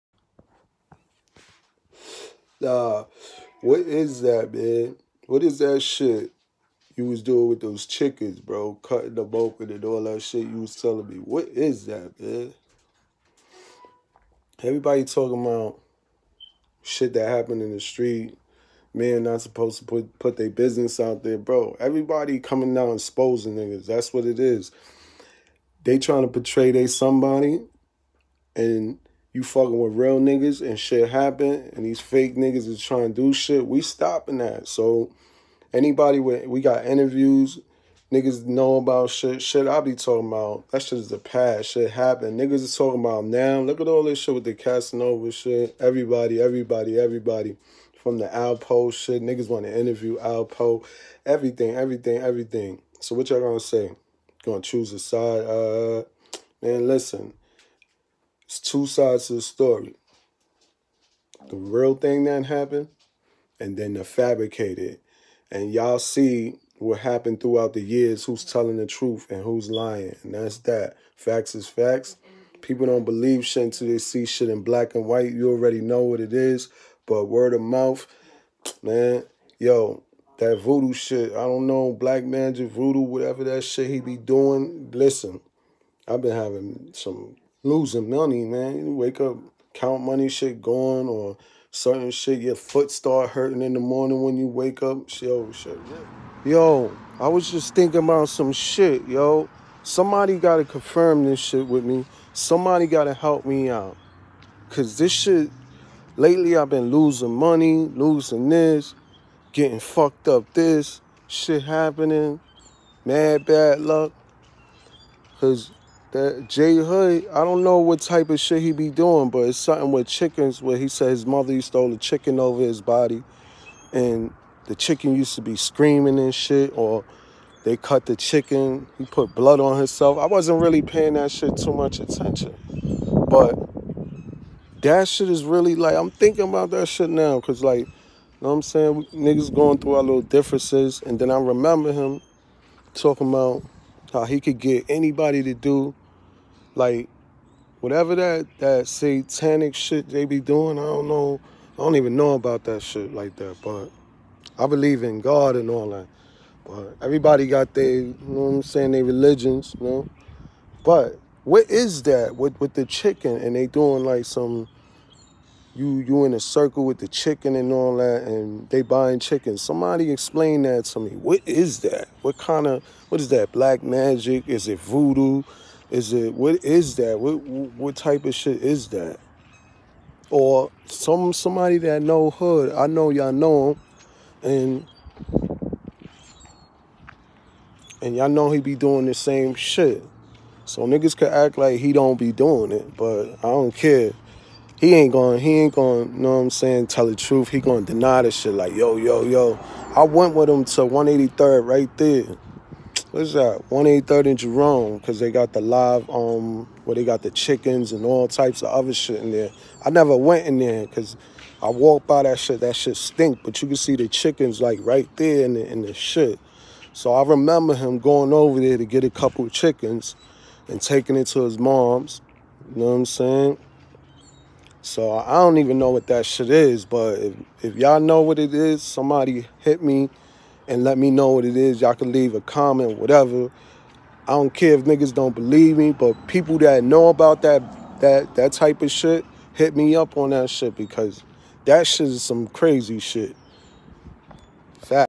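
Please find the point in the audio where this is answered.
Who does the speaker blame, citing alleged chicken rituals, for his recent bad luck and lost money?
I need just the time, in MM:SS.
01:56.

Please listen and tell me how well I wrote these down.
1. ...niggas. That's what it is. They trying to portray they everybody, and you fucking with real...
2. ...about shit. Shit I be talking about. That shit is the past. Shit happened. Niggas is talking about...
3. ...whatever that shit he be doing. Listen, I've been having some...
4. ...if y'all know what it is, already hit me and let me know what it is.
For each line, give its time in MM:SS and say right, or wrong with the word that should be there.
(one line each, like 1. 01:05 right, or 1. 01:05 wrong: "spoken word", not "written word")
1. 00:23 wrong: "somebody", not "everybody"
2. 00:38 right
3. 01:22 right
4. 03:47 wrong: "somebody", not "already".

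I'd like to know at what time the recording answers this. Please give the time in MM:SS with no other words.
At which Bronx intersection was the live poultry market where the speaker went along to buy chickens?
03:23.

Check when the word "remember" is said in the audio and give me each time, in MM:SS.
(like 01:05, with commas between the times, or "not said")
02:21, 03:37.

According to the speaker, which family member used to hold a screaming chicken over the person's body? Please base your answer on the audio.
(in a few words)
His mother.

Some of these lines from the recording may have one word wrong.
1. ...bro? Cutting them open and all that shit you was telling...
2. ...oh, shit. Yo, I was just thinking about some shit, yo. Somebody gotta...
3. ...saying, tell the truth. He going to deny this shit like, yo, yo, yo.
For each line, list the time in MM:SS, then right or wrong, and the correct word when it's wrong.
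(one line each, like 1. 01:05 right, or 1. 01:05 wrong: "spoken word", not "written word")
1. 00:08 right
2. 01:35 right
3. 03:16 right.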